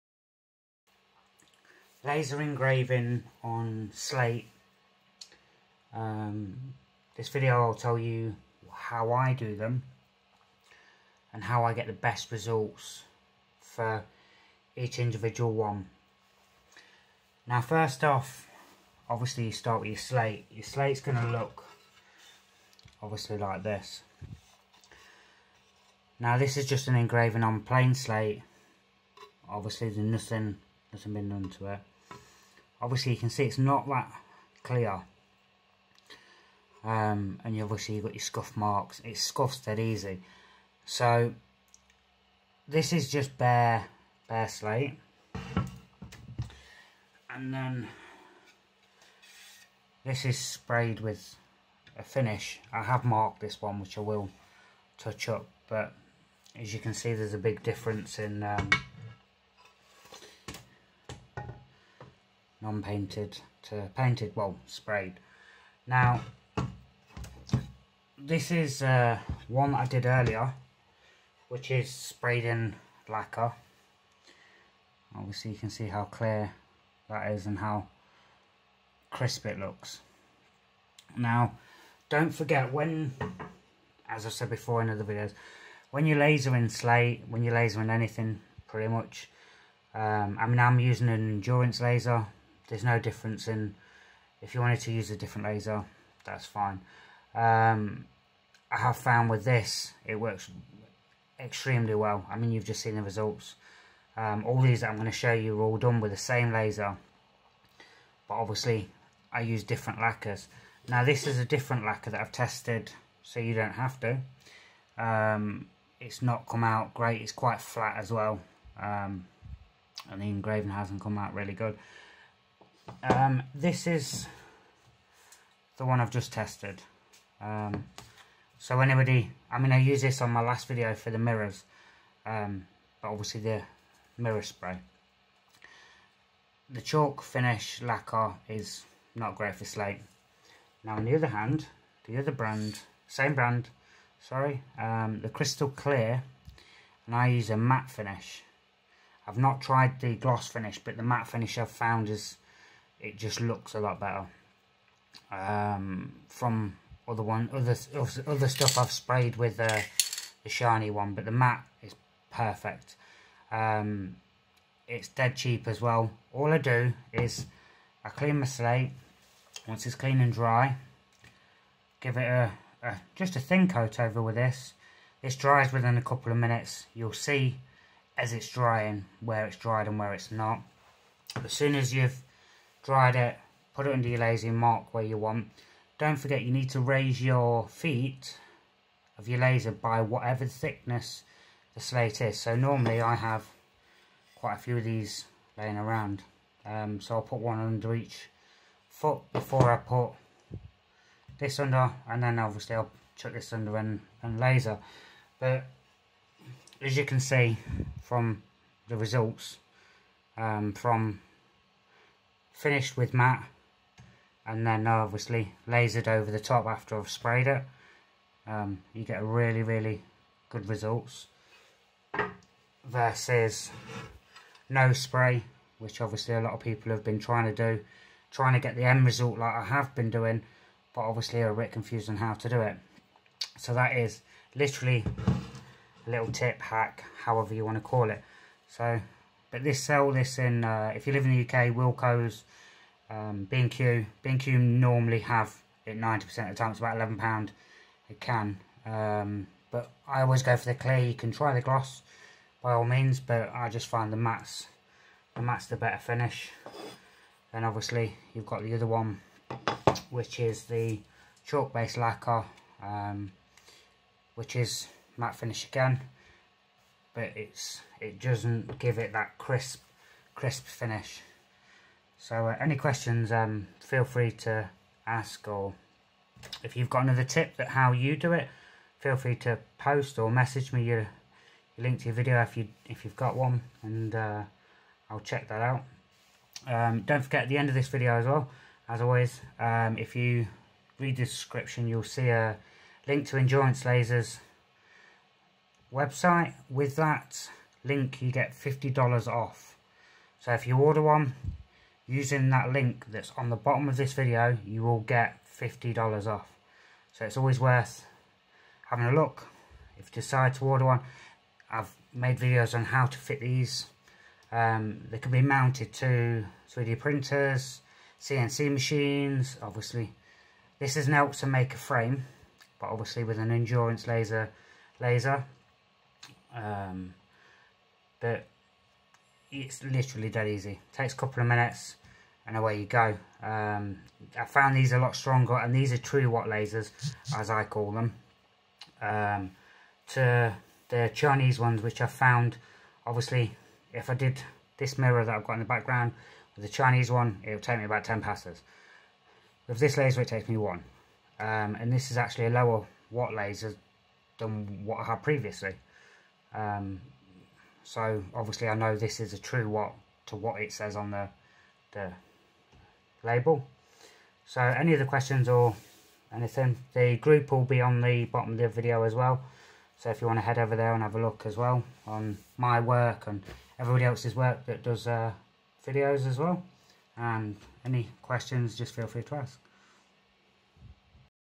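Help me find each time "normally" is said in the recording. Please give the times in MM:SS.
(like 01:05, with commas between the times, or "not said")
03:12, 04:04.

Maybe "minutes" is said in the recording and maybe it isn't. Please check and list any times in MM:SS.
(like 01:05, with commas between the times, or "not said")
02:56, 05:31.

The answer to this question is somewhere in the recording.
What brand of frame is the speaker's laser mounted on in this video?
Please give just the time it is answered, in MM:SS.
05:21.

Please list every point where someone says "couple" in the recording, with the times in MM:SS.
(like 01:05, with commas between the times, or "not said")
02:56, 05:31.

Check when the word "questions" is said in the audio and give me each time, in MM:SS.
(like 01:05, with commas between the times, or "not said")
04:32, 06:05, 06:18.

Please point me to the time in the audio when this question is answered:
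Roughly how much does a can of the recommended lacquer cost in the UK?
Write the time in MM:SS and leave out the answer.
04:06.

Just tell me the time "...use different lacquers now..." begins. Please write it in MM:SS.
01:49.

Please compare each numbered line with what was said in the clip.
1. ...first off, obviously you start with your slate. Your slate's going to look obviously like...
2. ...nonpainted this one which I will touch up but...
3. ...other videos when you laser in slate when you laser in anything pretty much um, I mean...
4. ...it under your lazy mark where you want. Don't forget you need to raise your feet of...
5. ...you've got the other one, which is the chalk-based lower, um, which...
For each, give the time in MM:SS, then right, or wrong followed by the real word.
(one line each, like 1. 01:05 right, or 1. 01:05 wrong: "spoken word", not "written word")
1. 00:17 right
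2. 00:53 wrong: "marked", not "nonpainted"
3. 01:24 right
4. 03:03 right
5. 04:18 wrong: "lacquer", not "lower".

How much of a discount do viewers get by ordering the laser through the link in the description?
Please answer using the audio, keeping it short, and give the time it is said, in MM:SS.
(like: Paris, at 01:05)
$50, at 04:58.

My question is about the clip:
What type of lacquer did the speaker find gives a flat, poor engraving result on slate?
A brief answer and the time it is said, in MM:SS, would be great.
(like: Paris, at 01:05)
Chalk finish lacquer, at 02:16.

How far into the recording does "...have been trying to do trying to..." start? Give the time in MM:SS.
03:46.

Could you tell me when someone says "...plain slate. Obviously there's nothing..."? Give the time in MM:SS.
00:27.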